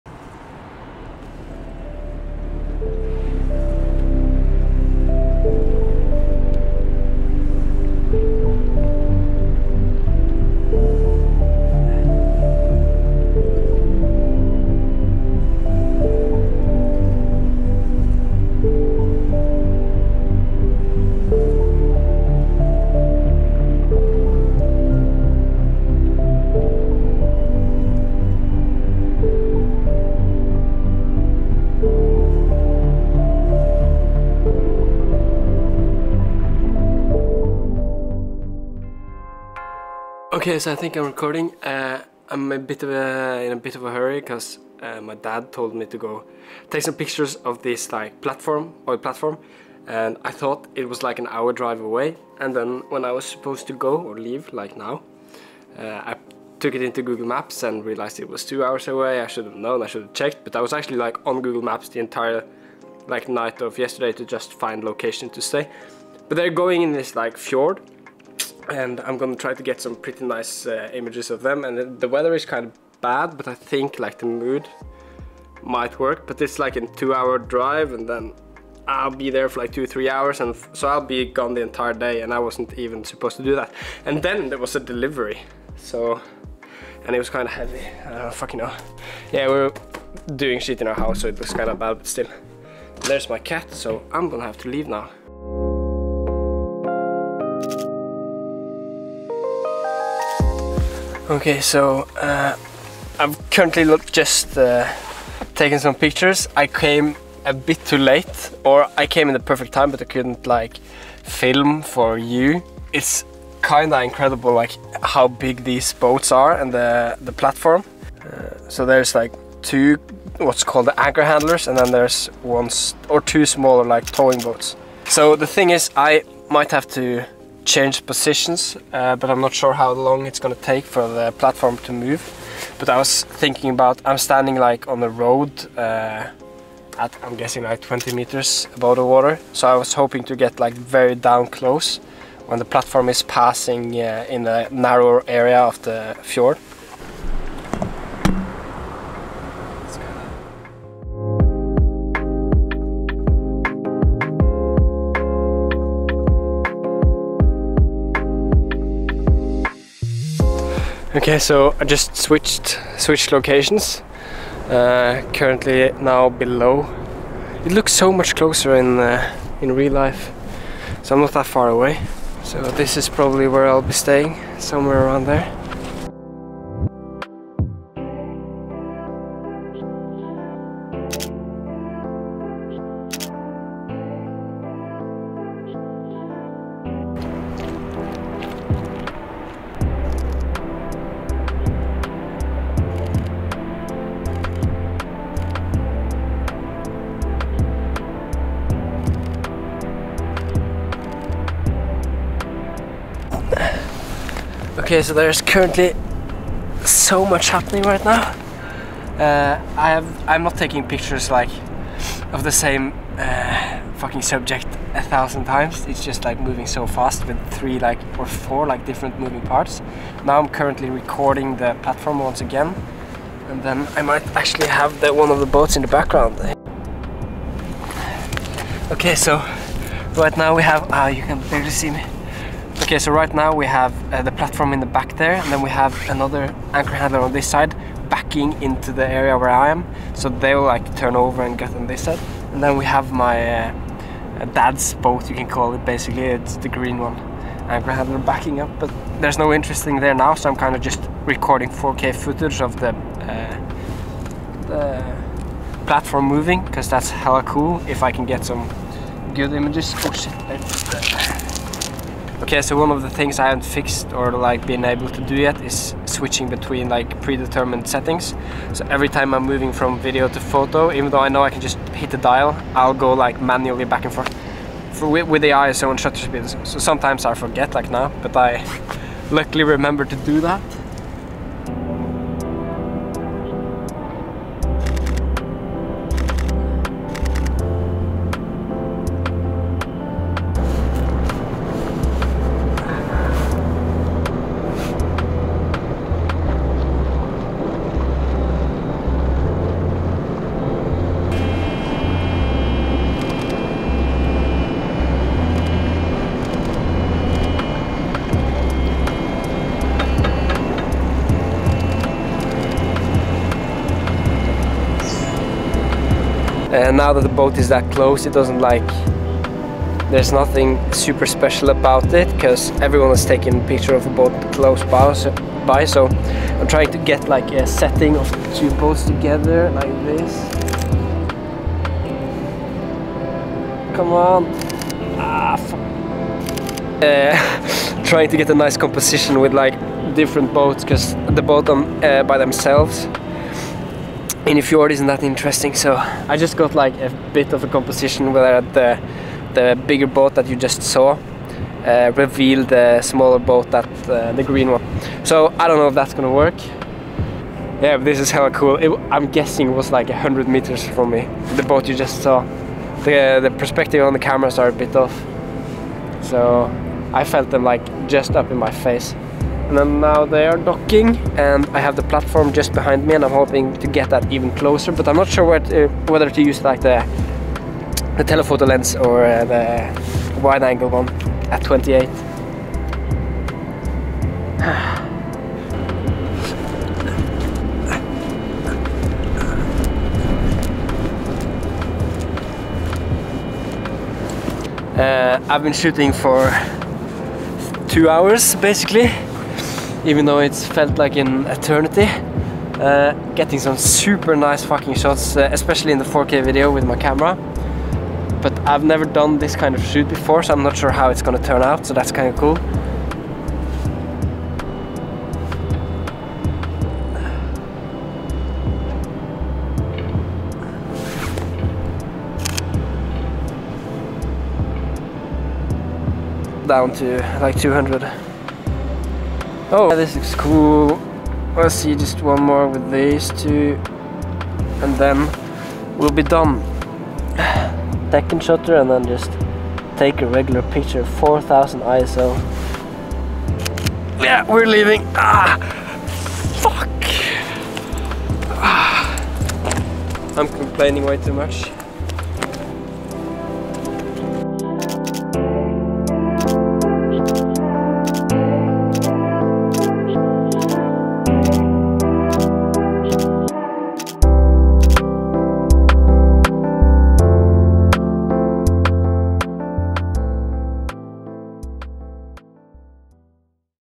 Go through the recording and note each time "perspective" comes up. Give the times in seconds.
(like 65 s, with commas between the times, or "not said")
363 s.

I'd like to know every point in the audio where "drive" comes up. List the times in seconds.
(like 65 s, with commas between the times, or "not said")
51 s, 77 s.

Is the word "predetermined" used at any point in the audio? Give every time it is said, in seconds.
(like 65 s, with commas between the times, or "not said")
267 s.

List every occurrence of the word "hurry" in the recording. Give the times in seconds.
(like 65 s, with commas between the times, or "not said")
43 s.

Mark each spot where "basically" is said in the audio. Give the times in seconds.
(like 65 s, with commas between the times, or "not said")
245 s, 398 s.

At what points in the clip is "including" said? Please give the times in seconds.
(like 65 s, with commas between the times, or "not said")
not said.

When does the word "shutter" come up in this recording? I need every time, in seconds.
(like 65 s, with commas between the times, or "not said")
275 s, 438 s.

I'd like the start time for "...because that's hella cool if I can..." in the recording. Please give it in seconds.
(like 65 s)
256 s.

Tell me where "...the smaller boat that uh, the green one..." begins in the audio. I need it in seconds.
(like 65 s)
352 s.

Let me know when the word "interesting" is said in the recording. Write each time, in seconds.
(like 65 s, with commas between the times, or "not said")
249 s, 345 s.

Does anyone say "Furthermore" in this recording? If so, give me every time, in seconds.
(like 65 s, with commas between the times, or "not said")
not said.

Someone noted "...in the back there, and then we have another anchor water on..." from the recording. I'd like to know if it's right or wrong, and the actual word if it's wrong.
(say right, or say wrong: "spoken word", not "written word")
wrong: "handler", not "water".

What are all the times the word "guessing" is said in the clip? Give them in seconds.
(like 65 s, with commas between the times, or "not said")
137 s, 359 s.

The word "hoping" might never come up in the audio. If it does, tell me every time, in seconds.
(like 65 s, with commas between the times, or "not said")
139 s, 373 s.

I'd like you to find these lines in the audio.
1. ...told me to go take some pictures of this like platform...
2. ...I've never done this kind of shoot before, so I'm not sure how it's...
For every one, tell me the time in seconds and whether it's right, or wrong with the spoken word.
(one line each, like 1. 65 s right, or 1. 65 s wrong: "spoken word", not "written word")
1. 45 s right
2. 408 s right.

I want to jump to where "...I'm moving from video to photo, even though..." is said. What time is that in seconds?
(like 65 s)
269 s.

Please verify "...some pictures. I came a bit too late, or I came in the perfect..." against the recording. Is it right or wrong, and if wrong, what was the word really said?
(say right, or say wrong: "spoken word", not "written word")
right.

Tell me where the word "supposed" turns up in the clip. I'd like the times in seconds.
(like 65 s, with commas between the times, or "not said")
53 s, 83 s.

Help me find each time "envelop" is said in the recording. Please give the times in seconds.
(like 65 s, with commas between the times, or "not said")
not said.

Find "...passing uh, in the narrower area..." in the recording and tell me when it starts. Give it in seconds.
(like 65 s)
143 s.